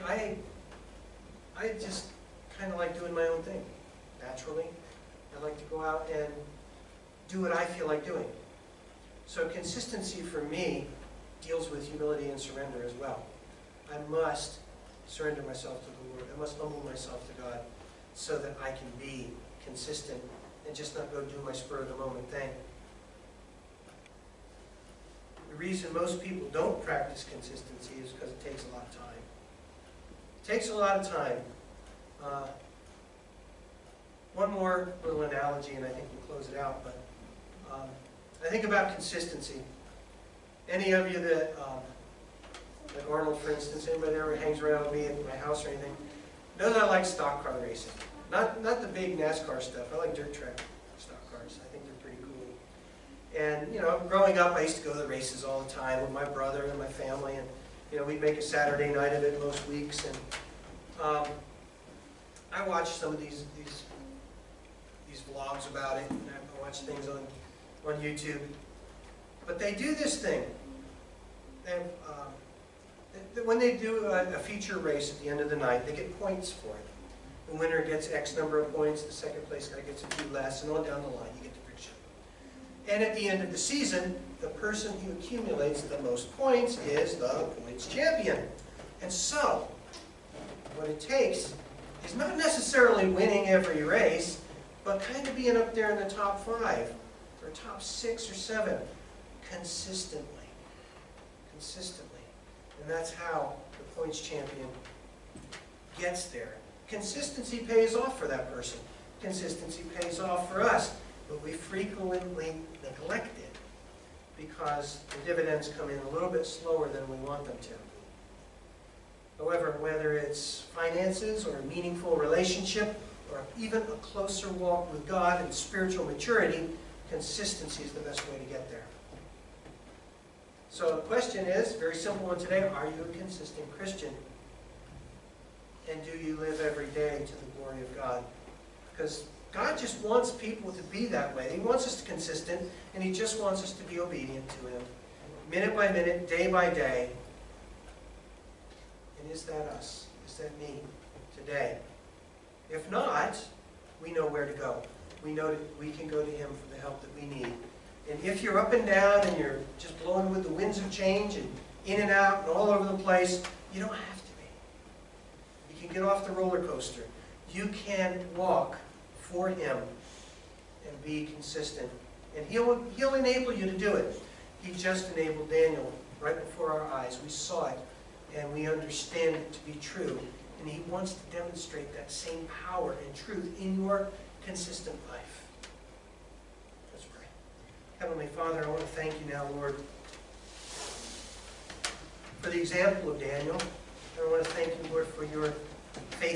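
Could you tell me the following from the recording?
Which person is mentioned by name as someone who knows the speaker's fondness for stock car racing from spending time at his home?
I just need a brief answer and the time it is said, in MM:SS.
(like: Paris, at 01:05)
Arnold, at 00:43.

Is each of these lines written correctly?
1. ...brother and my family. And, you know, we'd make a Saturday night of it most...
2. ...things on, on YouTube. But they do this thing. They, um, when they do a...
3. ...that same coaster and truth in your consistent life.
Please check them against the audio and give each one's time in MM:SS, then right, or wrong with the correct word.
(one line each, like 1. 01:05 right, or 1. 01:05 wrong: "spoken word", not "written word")
1. 00:56 right
2. 01:06 right
3. 03:01 wrong: "power", not "coaster".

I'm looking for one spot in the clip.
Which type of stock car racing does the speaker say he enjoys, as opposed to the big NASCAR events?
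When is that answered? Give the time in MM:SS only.
00:50.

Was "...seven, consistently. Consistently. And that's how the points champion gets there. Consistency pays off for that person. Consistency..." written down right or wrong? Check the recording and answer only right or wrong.
right.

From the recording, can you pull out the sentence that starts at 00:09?
So consistency for me deals with humility and surrender as well.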